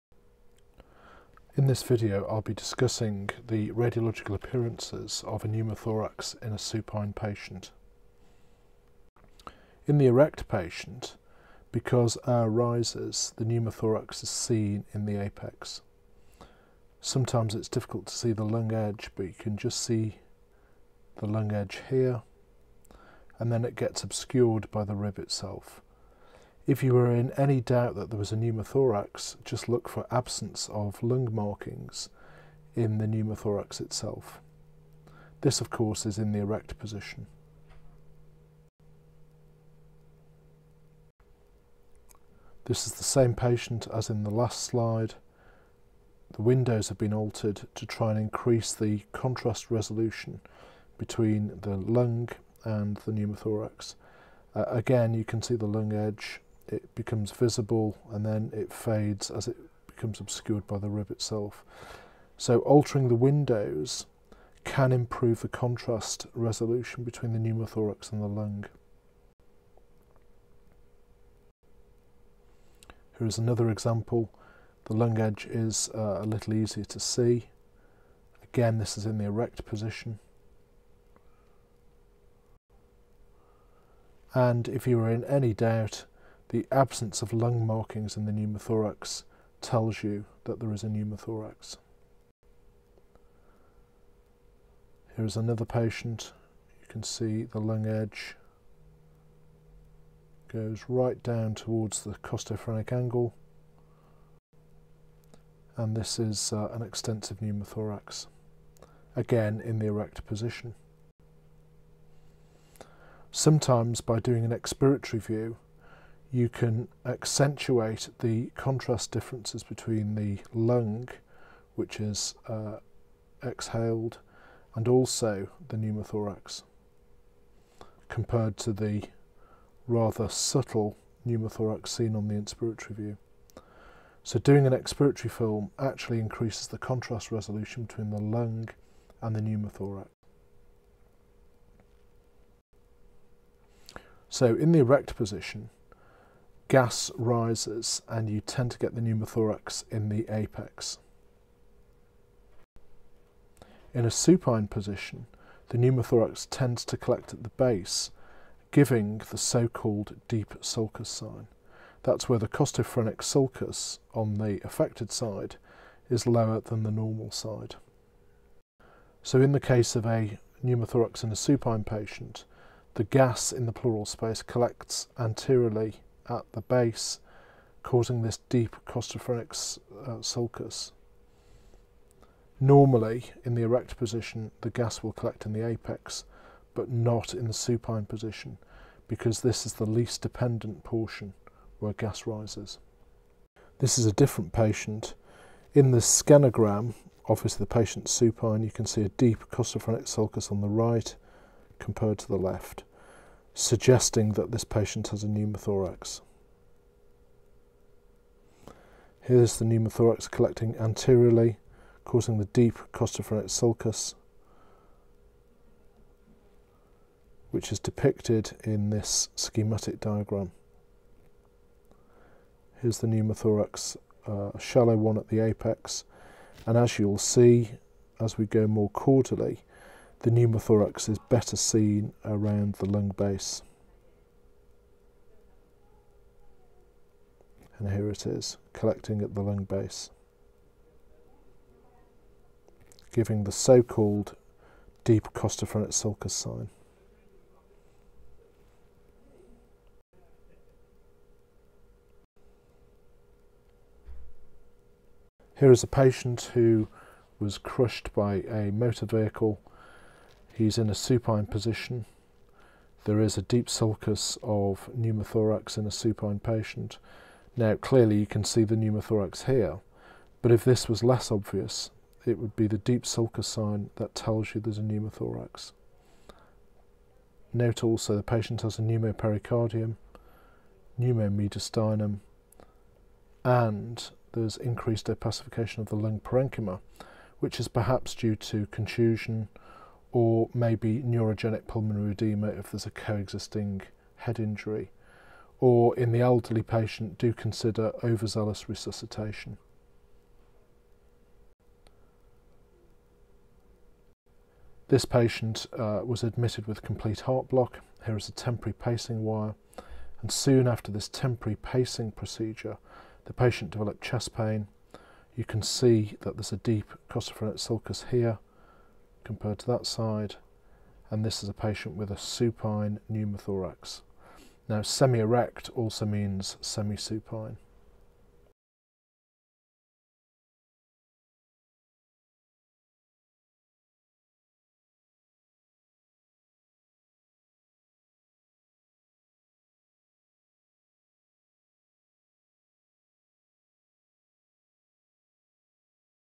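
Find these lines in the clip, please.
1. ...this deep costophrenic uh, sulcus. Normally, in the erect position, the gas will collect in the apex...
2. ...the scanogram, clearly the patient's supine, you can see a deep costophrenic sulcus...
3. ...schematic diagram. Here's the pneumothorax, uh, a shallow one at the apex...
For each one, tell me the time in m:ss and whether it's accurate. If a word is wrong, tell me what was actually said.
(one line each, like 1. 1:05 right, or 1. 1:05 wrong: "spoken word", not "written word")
1. 2:58 right
2. 3:15 wrong: "obviously", not "clearly"
3. 3:39 right.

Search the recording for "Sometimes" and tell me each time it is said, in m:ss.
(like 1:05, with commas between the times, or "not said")
0:17, 1:53.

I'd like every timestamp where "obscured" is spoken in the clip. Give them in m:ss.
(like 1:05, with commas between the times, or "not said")
0:24, 1:00.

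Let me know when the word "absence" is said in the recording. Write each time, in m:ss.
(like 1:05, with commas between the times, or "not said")
0:30, 1:26.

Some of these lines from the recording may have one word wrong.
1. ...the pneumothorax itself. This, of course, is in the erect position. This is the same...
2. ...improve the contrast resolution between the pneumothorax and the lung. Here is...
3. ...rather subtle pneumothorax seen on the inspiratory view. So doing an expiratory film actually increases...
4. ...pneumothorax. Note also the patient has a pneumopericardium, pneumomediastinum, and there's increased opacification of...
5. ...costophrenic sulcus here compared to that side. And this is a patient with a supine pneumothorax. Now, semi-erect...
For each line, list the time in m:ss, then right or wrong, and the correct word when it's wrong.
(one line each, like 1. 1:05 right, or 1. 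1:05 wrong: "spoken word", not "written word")
1. 0:32 right
2. 1:04 right
3. 2:09 right
4. 4:34 right
5. 5:17 right.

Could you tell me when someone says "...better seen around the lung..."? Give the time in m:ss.
3:51.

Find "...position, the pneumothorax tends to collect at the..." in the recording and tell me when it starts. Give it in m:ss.
2:34.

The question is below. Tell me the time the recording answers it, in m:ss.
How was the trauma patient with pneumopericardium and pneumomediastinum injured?
4:17.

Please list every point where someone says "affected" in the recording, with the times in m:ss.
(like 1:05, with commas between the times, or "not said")
2:44.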